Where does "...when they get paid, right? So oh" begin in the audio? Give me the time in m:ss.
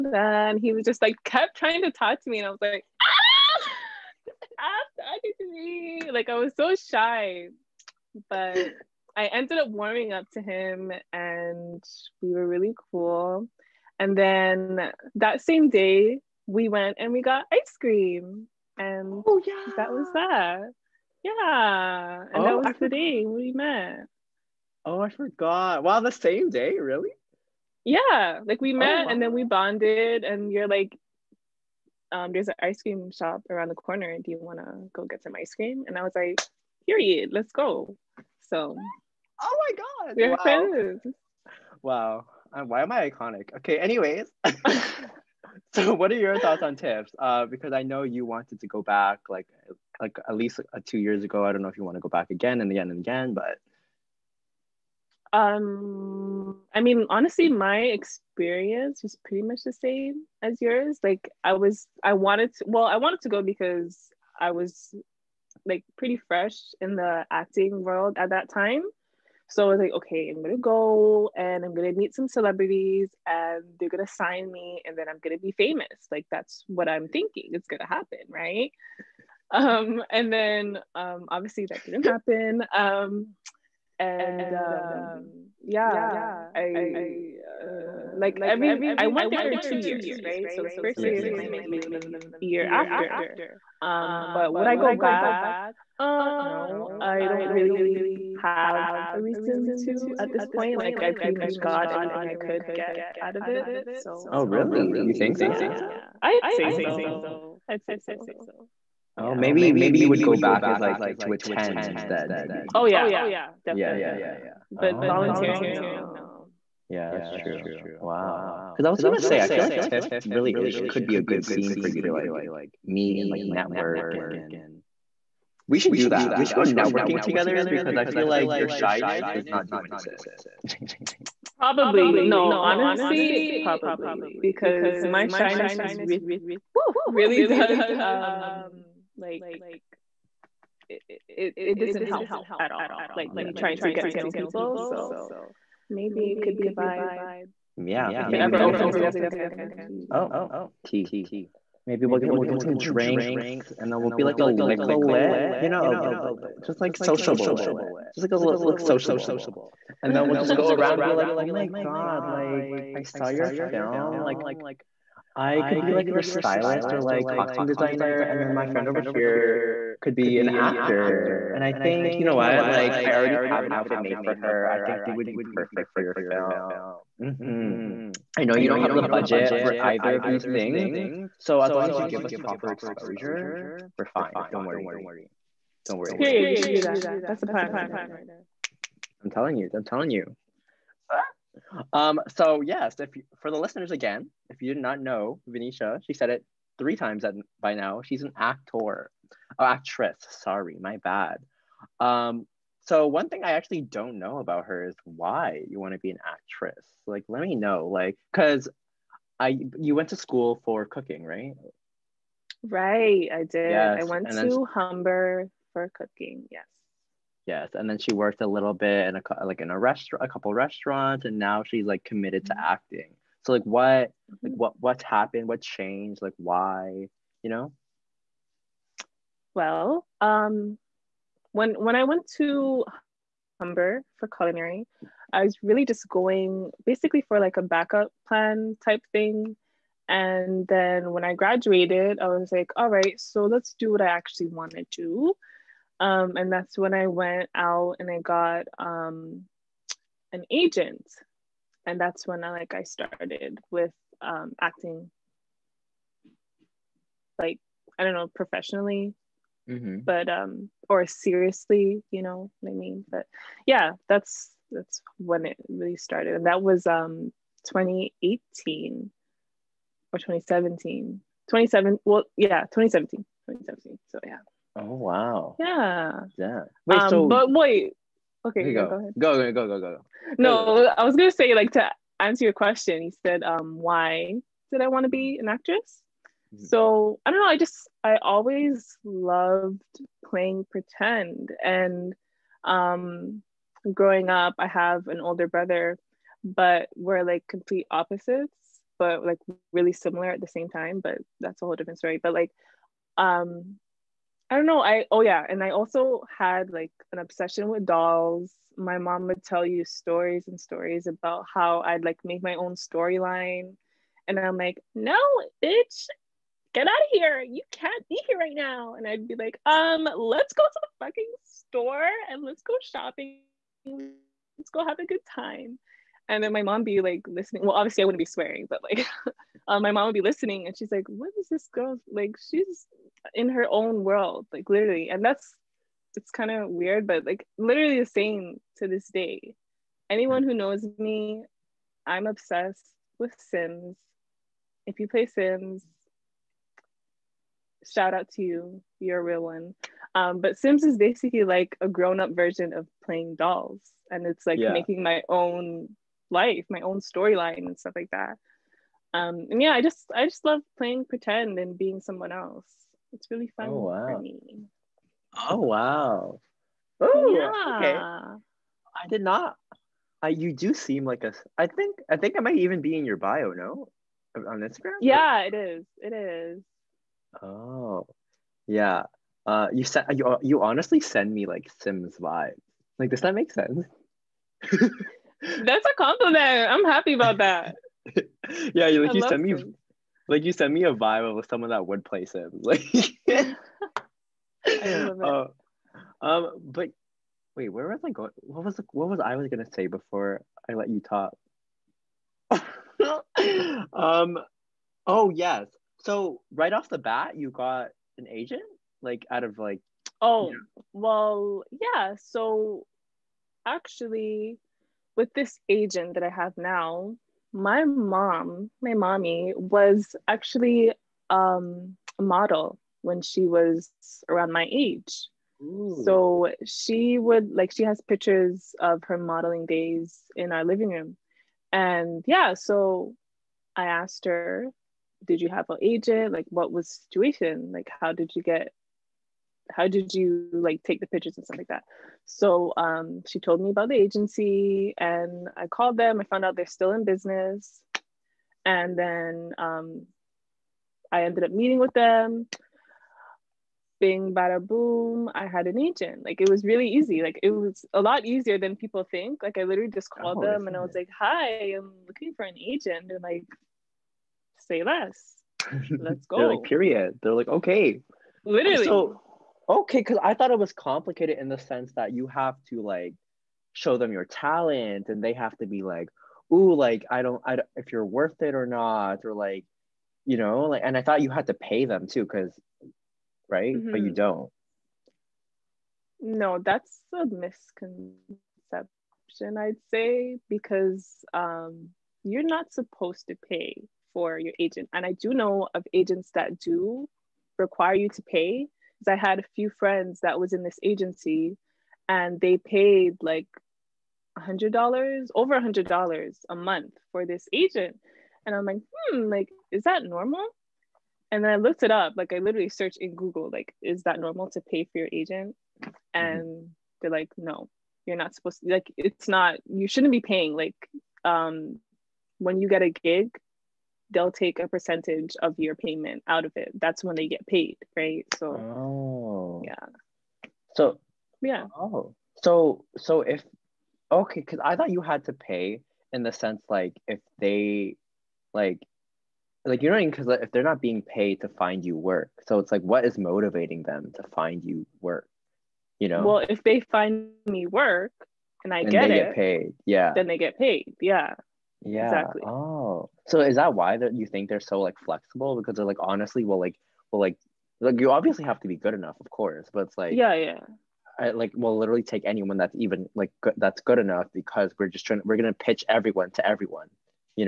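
8:47.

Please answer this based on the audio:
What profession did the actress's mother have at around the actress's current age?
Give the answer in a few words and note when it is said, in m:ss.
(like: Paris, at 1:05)
Model, at 7:02.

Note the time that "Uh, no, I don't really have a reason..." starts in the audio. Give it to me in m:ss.
1:35.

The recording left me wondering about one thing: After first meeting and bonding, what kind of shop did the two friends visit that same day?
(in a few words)
Ice cream shop.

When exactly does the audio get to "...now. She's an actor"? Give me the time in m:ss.
3:17.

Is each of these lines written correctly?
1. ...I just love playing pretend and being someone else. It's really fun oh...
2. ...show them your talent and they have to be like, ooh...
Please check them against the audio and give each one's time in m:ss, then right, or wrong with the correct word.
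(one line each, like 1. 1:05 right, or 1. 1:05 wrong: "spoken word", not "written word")
1. 6:00 right
2. 7:53 right.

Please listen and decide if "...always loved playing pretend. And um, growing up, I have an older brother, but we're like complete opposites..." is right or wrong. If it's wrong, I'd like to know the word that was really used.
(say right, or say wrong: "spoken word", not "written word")
right.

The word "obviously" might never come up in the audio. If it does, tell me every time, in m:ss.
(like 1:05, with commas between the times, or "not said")
1:21, 5:27, 9:18.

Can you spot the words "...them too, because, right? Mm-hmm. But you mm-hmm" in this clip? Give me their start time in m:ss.
8:01.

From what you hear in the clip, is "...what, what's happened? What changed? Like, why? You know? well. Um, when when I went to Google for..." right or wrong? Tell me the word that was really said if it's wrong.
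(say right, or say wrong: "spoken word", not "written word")
wrong: "Humber", not "Google".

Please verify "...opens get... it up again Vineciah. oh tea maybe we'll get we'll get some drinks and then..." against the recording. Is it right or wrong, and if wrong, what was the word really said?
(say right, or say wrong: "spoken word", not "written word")
wrong: "Jeez", not "Vineciah".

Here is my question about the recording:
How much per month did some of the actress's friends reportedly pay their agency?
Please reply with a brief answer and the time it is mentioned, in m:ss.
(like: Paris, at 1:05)
Over $100, at 8:25.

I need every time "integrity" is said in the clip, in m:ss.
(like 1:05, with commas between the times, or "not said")
not said.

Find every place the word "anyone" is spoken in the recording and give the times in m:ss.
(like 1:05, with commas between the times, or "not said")
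5:40, 9:22.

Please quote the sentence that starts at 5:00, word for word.
But that's a whole different story.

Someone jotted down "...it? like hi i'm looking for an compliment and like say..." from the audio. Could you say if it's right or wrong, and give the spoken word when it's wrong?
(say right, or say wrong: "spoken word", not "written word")
wrong: "agent", not "compliment".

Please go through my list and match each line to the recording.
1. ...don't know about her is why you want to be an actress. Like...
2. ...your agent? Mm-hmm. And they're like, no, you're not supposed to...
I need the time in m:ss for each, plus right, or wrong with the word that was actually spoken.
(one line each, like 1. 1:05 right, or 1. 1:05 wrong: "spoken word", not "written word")
1. 3:23 right
2. 8:34 right.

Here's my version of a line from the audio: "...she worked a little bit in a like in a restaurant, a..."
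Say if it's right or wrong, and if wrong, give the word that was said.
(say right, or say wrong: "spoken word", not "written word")
right.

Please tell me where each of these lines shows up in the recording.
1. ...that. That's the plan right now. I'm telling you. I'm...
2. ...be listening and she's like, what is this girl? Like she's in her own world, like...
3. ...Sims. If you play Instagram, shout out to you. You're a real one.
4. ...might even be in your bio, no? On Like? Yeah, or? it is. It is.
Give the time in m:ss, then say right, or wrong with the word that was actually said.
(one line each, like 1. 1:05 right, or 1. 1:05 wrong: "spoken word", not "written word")
1. 3:06 right
2. 5:30 right
3. 5:43 wrong: "Sims", not "Instagram"
4. 6:12 wrong: "Instagram", not "Like".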